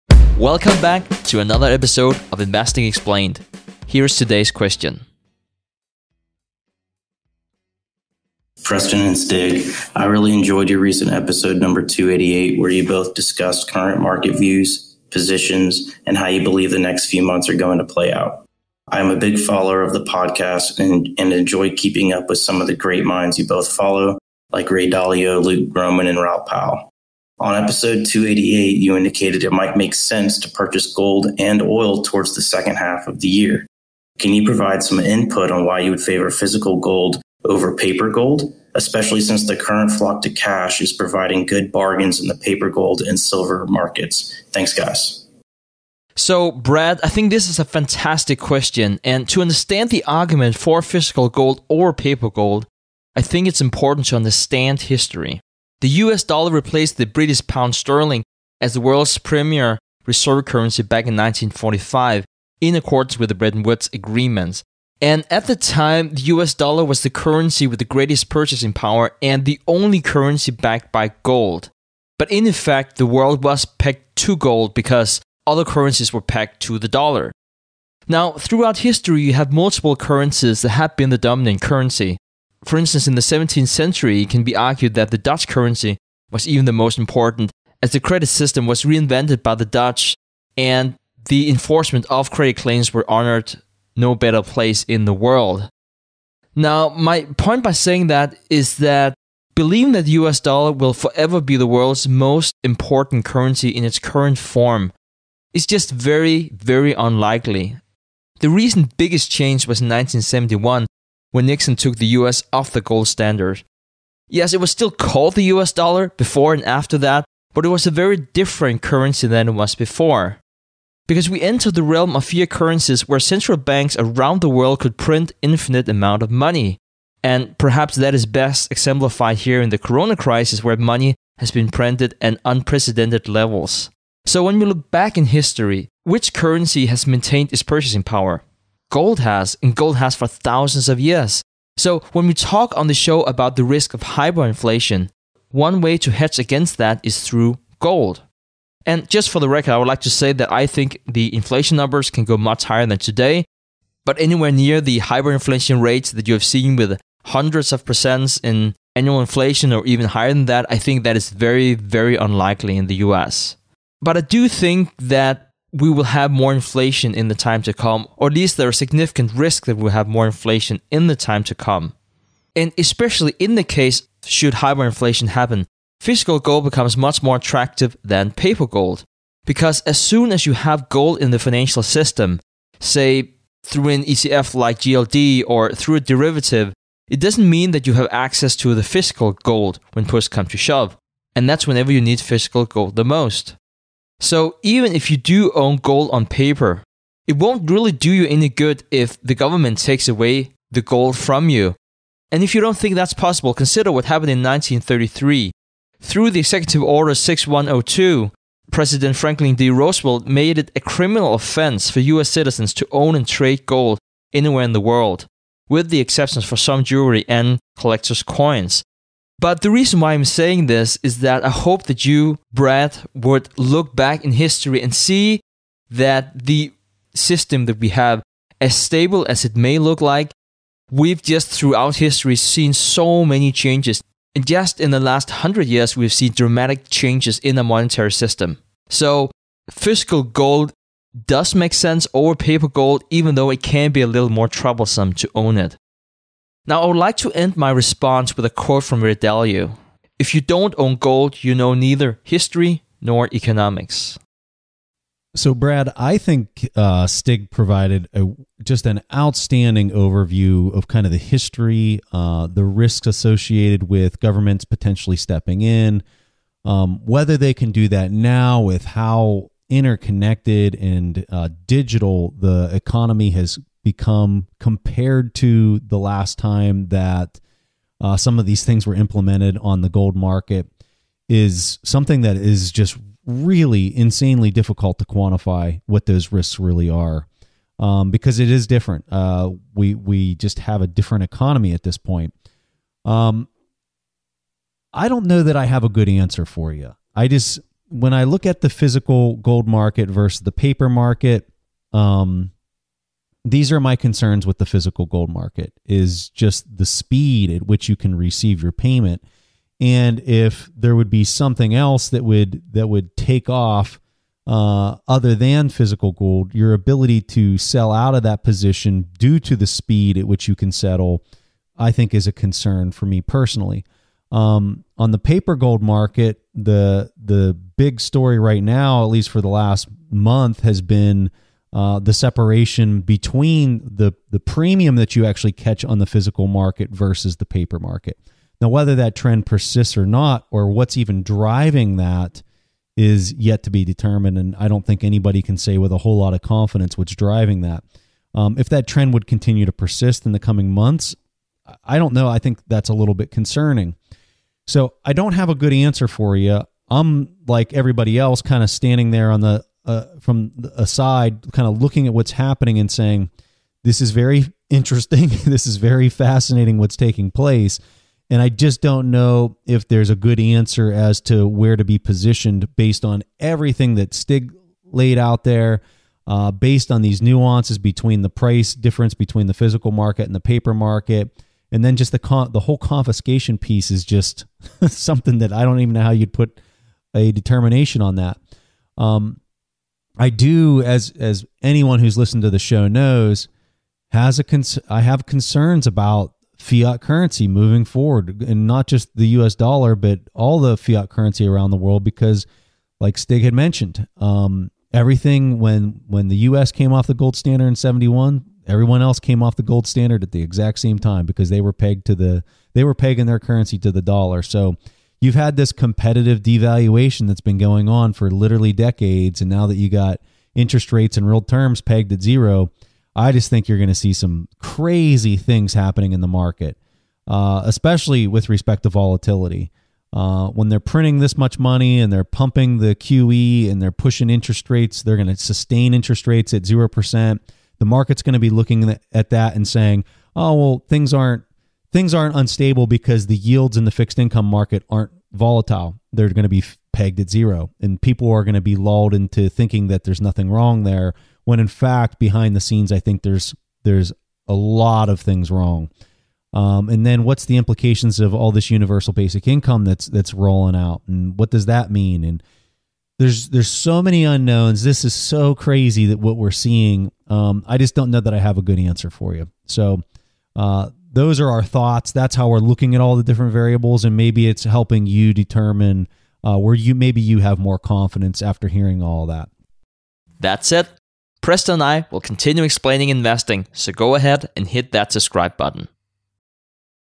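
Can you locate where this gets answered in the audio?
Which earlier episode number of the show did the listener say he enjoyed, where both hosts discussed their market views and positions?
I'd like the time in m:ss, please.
0:11.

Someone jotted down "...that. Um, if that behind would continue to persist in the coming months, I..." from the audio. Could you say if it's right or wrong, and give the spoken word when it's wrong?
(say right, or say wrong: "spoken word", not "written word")
wrong: "trend", not "behind".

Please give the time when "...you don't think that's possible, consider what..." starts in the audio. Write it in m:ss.
3:22.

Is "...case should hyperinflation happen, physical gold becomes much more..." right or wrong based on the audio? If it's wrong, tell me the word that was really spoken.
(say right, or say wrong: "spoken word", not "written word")
right.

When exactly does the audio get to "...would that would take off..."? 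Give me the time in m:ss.
5:12.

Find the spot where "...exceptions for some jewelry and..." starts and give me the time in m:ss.
3:35.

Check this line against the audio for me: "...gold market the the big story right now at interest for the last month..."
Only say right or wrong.
wrong.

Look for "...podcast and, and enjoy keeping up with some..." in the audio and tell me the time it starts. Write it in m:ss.
0:20.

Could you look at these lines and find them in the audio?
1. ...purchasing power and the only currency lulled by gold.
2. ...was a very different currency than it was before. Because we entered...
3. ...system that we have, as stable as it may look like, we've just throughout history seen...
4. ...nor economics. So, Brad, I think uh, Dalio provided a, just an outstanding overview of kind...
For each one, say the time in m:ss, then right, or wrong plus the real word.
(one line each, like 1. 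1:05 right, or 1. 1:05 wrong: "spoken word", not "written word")
1. 1:08 wrong: "backed", not "lulled"
2. 1:57 right
3. 3:47 right
4. 4:13 wrong: "Stig", not "Dalio".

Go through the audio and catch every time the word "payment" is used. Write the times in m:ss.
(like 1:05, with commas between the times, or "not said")
5:08.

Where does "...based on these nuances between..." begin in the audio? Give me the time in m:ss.
6:16.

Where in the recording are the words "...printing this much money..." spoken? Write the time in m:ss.
7:10.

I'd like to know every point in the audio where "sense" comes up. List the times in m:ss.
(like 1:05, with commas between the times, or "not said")
0:29, 4:01.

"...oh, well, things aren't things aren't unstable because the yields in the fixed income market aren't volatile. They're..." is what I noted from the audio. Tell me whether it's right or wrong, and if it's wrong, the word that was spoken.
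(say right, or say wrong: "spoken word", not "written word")
right.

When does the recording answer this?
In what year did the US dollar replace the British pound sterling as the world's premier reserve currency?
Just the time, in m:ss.
1:01.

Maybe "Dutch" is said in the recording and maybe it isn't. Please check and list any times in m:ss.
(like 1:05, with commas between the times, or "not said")
1:25, 1:29.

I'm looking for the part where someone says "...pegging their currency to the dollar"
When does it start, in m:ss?
6:52.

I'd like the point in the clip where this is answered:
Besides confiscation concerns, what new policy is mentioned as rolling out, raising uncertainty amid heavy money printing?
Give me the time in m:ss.
7:38.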